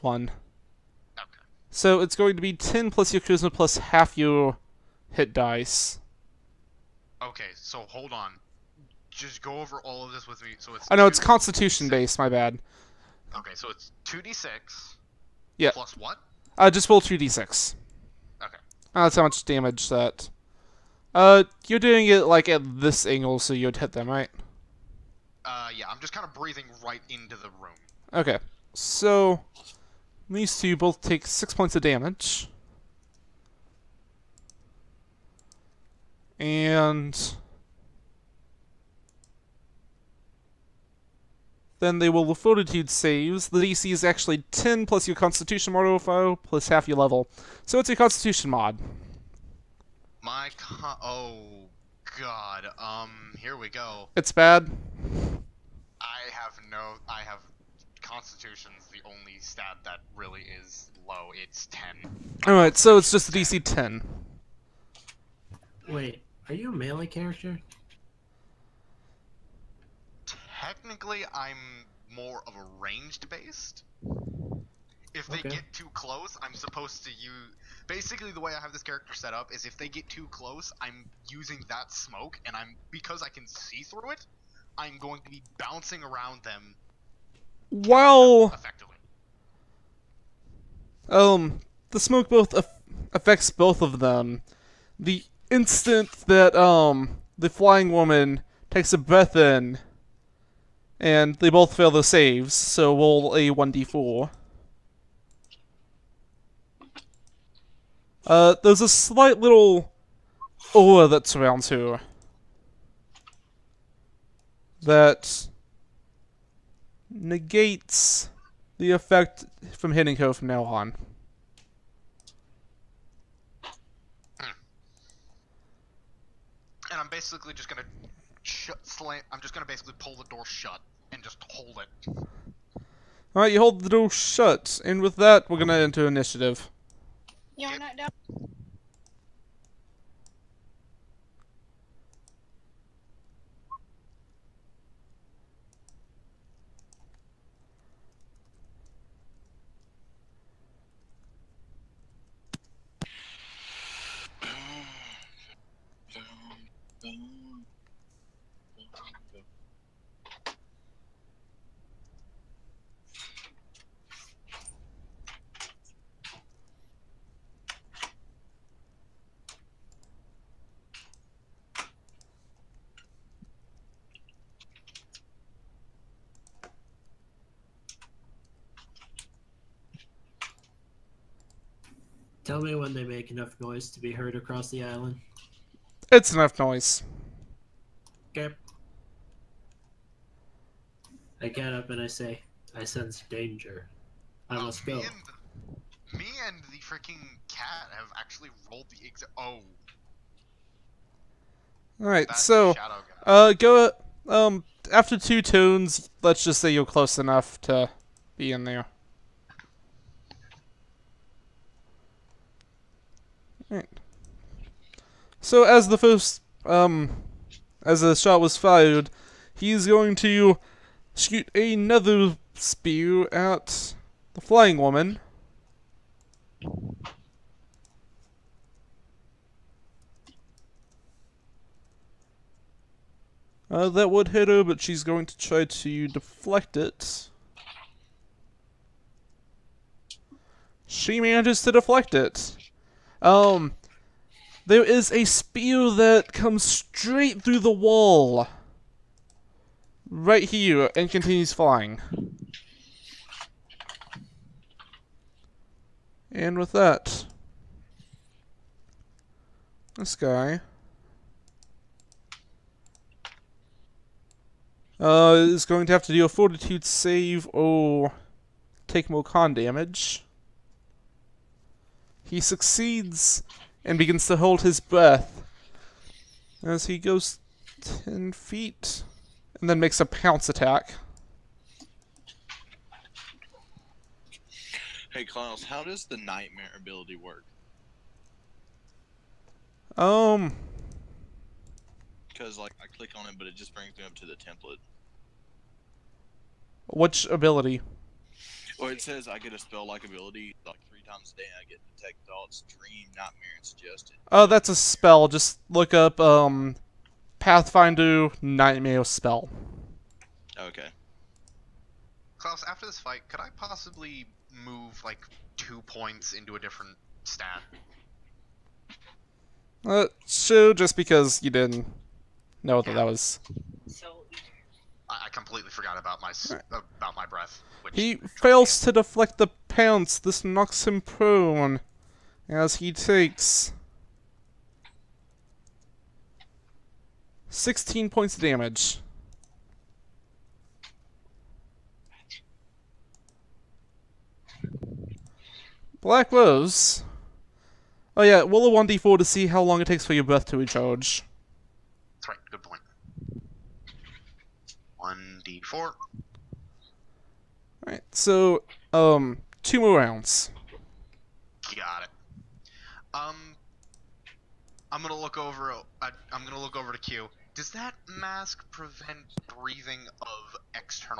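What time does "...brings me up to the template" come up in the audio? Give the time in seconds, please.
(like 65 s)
293 s.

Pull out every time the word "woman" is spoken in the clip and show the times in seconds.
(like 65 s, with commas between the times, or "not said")
97 s, 224 s.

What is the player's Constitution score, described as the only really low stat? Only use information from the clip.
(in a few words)
10.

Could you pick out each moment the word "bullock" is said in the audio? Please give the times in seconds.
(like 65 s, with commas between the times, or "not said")
not said.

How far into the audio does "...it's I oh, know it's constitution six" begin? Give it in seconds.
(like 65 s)
10 s.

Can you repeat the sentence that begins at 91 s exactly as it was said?
Um, the smoke both affects both of them.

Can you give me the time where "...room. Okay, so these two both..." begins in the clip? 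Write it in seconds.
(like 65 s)
27 s.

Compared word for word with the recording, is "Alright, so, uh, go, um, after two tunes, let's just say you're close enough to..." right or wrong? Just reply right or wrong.
right.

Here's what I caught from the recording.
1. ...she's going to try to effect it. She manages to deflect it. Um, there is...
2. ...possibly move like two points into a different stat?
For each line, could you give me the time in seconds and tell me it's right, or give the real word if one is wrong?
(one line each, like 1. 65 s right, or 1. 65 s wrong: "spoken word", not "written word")
1. 234 s wrong: "deflect", not "effect"
2. 313 s right.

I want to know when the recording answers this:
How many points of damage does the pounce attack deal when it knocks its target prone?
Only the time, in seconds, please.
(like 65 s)
337 s.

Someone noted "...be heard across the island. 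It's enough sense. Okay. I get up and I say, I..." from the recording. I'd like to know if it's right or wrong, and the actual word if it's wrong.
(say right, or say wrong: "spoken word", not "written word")
wrong: "noise", not "sense".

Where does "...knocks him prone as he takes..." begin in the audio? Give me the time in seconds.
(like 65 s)
330 s.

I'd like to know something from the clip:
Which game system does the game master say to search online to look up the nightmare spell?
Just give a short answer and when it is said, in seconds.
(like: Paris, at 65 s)
Pathfinder, at 307 s.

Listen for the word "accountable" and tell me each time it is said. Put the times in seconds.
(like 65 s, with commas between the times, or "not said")
not said.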